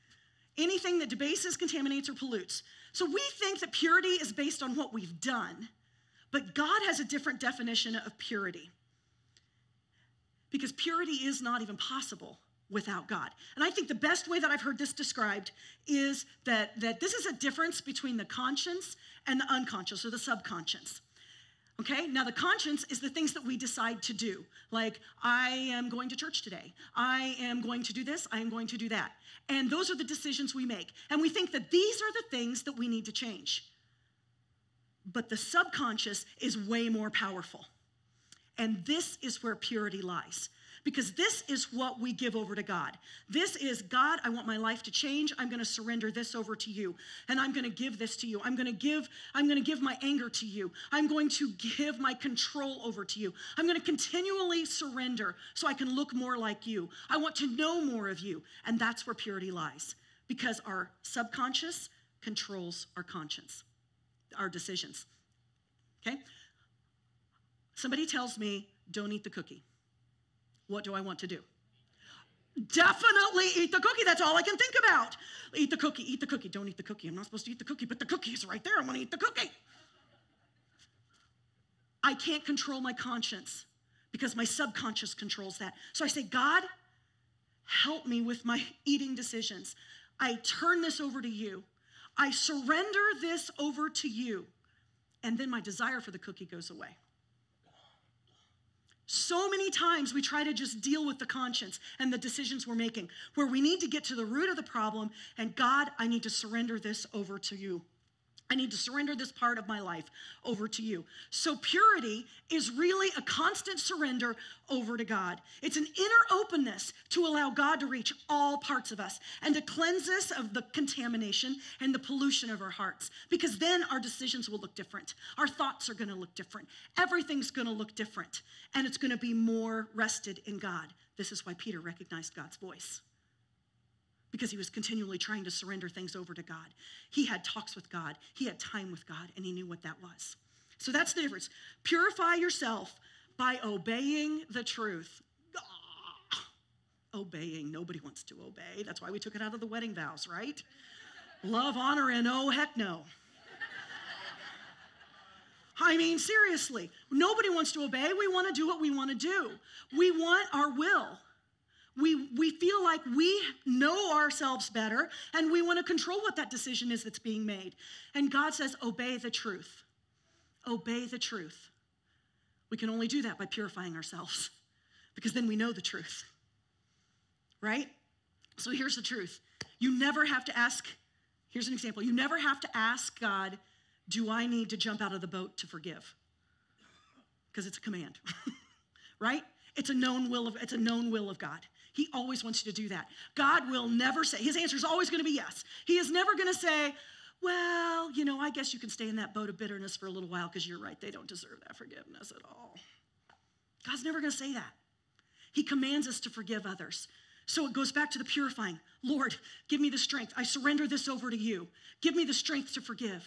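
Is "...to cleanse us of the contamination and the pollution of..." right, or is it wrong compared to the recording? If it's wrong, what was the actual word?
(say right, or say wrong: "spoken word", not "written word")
right.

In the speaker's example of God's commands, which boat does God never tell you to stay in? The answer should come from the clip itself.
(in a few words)
boat of bitterness.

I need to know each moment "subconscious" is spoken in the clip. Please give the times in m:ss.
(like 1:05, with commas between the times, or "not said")
0:20, 0:35, 1:01, 1:24.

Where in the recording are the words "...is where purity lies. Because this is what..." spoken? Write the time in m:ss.
0:39.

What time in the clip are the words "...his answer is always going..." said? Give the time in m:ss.
3:14.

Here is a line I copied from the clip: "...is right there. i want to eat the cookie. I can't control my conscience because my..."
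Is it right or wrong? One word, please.
right.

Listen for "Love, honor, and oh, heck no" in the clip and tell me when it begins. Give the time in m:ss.
2:31.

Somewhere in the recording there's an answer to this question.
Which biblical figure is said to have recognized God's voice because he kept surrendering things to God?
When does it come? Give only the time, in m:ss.
2:11.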